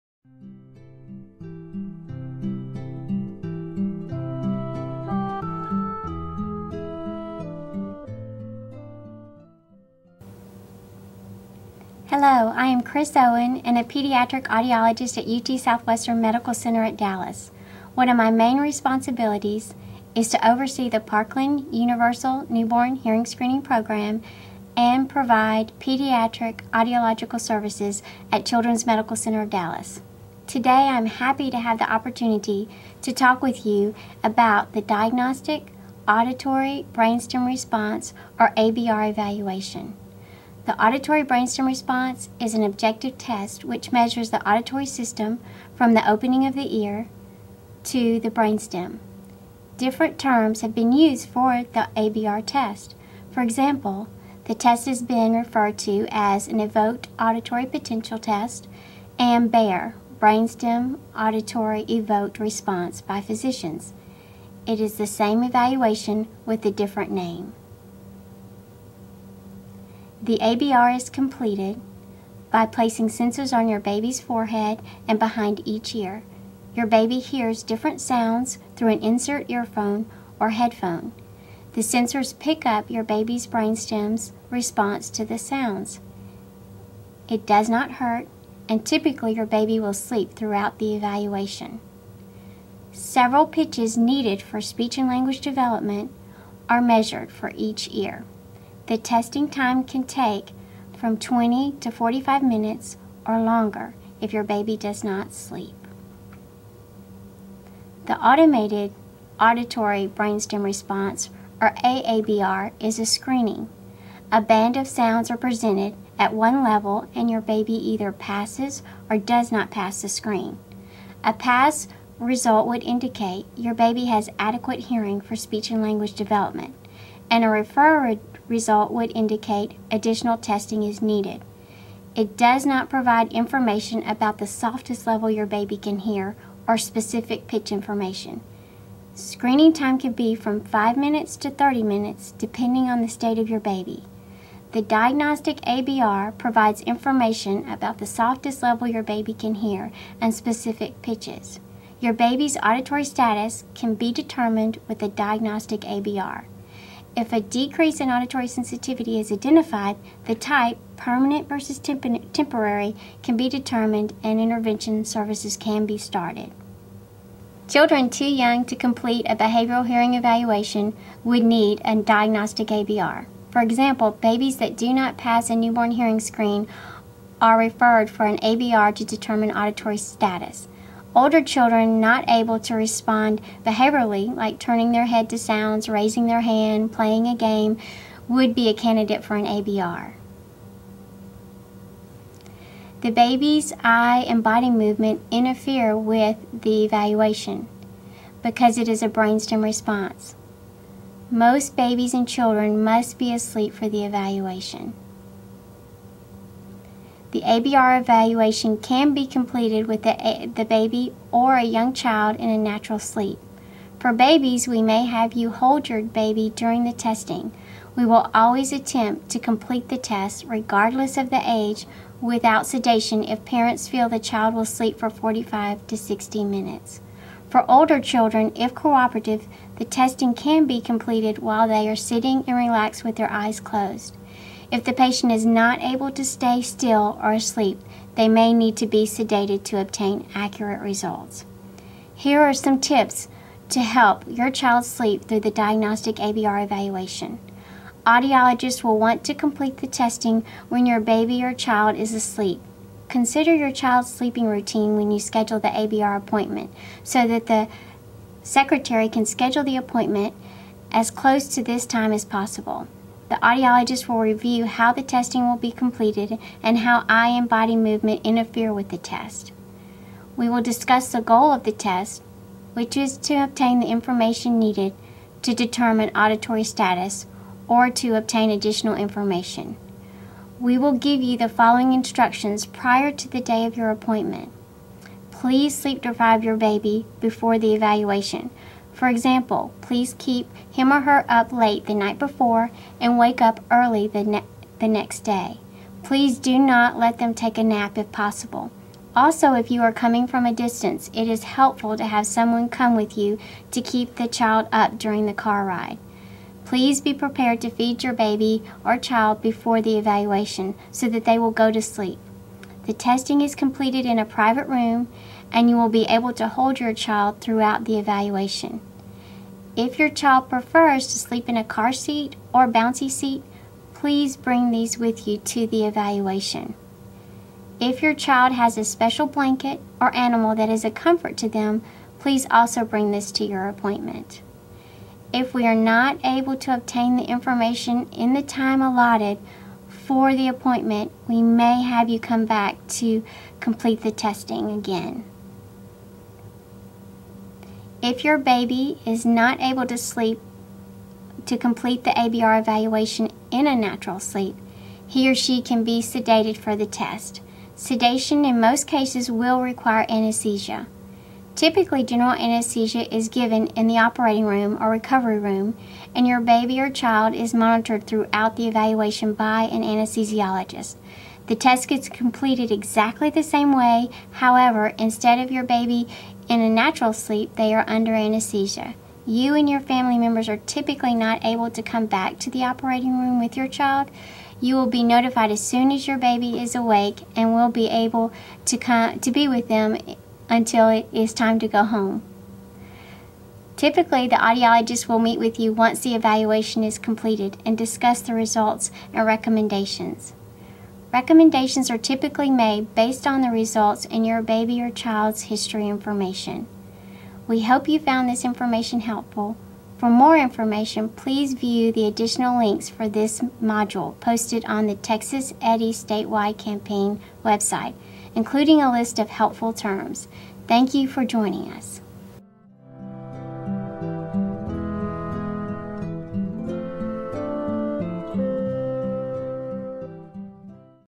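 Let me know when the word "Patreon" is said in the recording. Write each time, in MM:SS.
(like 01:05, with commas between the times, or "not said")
not said.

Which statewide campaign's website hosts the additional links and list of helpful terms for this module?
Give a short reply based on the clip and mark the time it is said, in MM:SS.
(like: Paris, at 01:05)
Texas EHDI, at 06:54.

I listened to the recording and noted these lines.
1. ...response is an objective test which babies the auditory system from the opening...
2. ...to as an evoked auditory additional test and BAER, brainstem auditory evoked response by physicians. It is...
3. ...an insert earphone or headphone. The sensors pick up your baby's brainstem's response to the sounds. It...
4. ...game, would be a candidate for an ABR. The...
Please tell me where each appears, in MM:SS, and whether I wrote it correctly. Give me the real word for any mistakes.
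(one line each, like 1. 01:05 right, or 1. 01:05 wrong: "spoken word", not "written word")
1. 00:41 wrong: "measures", not "babies"
2. 00:55 wrong: "potential", not "additional"
3. 01:18 right
4. 03:07 right.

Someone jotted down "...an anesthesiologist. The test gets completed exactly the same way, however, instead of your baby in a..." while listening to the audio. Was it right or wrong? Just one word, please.
right.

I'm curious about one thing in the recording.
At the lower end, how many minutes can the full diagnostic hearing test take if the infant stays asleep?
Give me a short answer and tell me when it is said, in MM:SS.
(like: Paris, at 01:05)
20, at 01:41.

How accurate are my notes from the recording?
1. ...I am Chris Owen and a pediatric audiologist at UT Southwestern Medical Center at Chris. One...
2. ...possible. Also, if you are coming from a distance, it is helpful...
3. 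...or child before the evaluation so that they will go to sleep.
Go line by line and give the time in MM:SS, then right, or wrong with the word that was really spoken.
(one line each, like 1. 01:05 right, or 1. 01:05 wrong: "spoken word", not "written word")
1. 00:12 wrong: "Dallas", not "Chris"
2. 04:58 right
3. 05:08 right.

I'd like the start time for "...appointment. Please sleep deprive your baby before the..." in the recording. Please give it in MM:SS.
04:43.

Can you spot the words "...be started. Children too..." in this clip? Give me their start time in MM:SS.
02:45.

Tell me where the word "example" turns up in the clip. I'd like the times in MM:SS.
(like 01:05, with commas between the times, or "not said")
00:53, 02:53, 04:49.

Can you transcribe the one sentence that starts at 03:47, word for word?
For older children, if cooperative, the testing can be completed while they are sitting and relaxed with their eyes closed.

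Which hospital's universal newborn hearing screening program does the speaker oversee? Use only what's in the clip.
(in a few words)
Parkland.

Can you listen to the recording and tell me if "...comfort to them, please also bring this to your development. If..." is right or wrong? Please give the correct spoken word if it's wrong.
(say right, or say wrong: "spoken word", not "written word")
wrong: "appointment", not "development".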